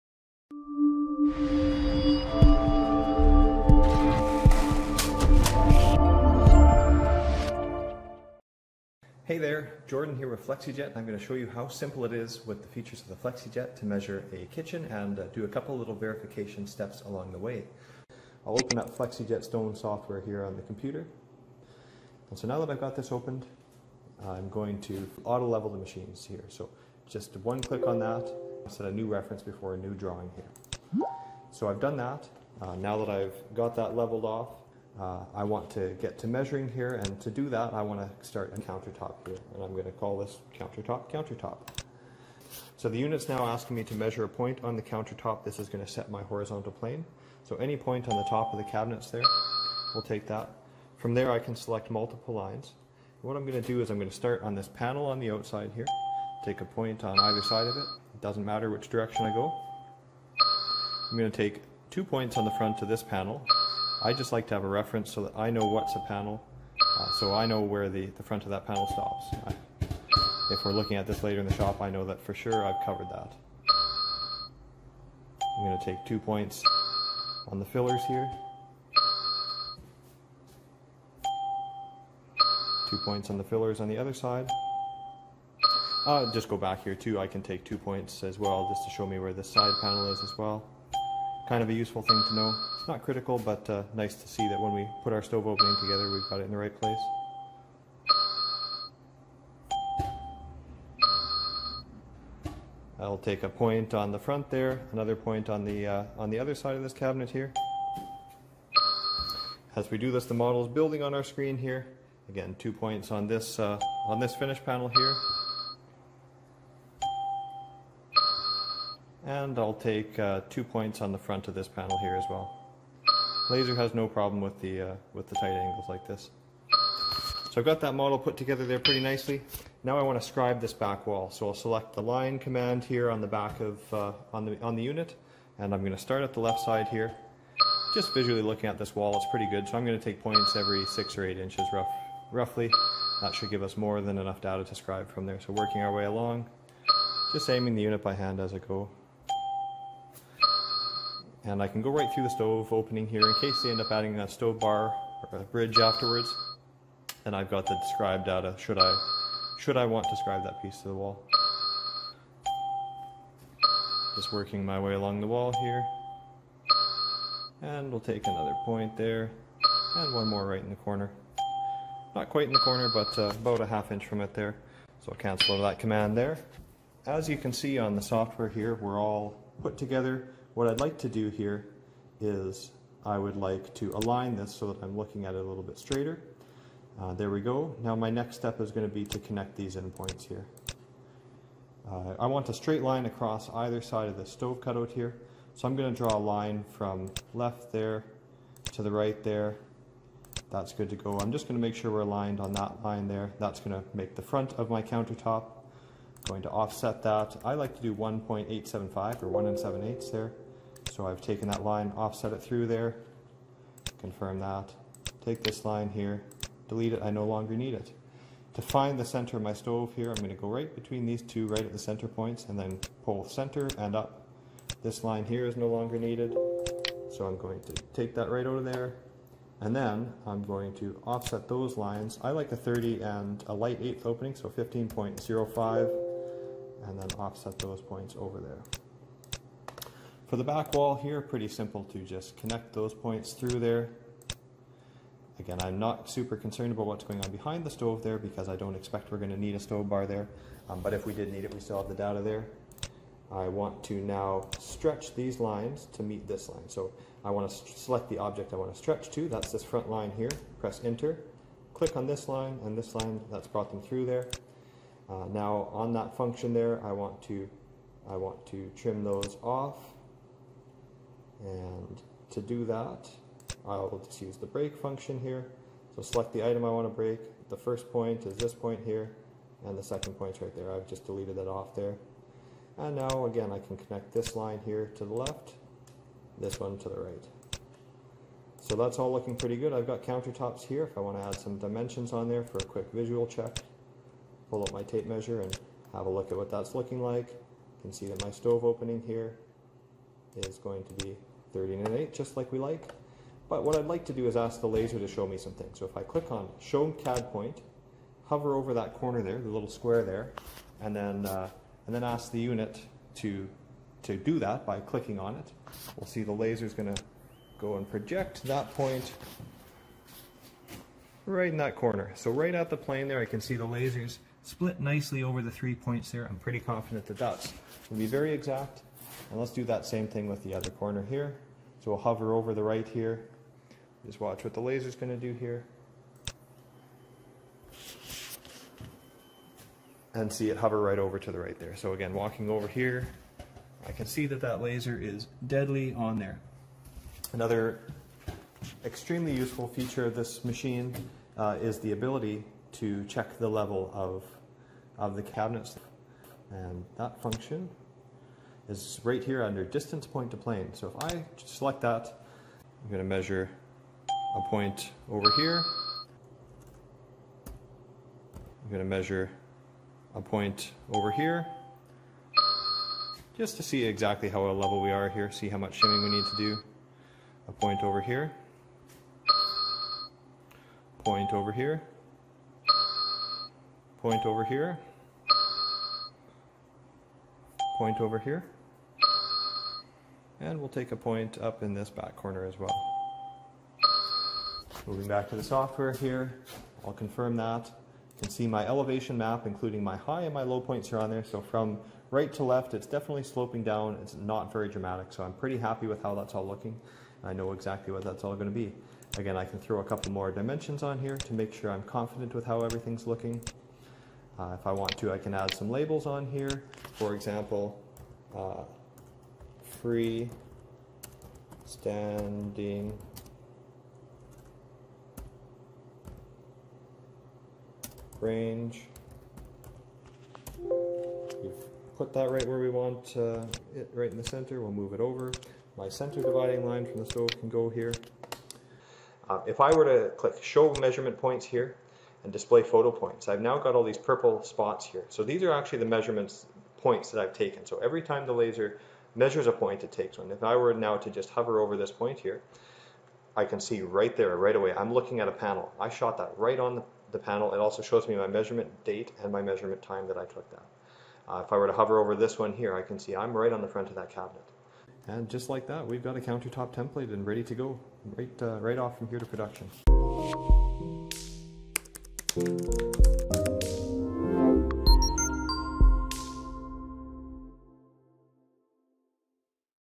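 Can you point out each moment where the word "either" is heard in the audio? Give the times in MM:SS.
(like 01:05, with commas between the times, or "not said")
00:57, 03:13.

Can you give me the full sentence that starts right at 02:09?
Now I want to scribe this back wall.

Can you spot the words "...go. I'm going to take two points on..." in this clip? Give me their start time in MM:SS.
00:59.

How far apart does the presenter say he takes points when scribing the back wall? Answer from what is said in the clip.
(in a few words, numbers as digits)
6 or 8 inches.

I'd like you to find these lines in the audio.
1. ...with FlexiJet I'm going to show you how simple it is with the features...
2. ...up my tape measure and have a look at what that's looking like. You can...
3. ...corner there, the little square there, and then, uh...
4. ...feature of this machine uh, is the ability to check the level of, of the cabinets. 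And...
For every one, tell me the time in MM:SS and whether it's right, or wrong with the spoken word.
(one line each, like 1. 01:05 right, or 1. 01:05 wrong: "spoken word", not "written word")
1. 00:10 right
2. 04:54 right
3. 05:08 right
4. 05:49 right.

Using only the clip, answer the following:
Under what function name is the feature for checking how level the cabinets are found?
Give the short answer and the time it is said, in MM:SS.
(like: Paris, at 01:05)
distance point to plane, at 05:59.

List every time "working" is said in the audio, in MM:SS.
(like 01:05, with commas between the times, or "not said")
02:25, 02:44.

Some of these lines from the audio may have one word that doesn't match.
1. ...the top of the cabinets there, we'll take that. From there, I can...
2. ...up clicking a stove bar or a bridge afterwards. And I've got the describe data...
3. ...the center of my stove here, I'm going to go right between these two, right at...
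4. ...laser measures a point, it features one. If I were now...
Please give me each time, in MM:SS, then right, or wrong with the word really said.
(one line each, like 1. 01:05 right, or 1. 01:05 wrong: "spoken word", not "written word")
1. 00:48 right
2. 02:33 wrong: "adding", not "clicking"
3. 03:38 right
4. 07:28 wrong: "takes", not "features".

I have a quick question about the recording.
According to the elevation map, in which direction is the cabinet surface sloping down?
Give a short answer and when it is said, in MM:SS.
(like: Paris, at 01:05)
from right to left, at 06:41.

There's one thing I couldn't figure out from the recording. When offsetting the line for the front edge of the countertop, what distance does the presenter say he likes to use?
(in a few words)
1.875.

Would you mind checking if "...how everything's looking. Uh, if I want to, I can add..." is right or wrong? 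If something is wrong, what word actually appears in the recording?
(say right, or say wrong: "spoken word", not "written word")
right.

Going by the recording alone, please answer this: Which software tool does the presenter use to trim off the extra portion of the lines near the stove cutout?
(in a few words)
break function.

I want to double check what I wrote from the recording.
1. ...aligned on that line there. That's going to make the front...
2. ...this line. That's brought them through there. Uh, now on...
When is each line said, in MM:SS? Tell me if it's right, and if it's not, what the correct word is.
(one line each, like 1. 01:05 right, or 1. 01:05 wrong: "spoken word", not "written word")
1. 03:22 right
2. 04:22 right.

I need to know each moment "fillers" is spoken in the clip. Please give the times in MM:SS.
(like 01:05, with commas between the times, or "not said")
01:17, 01:23.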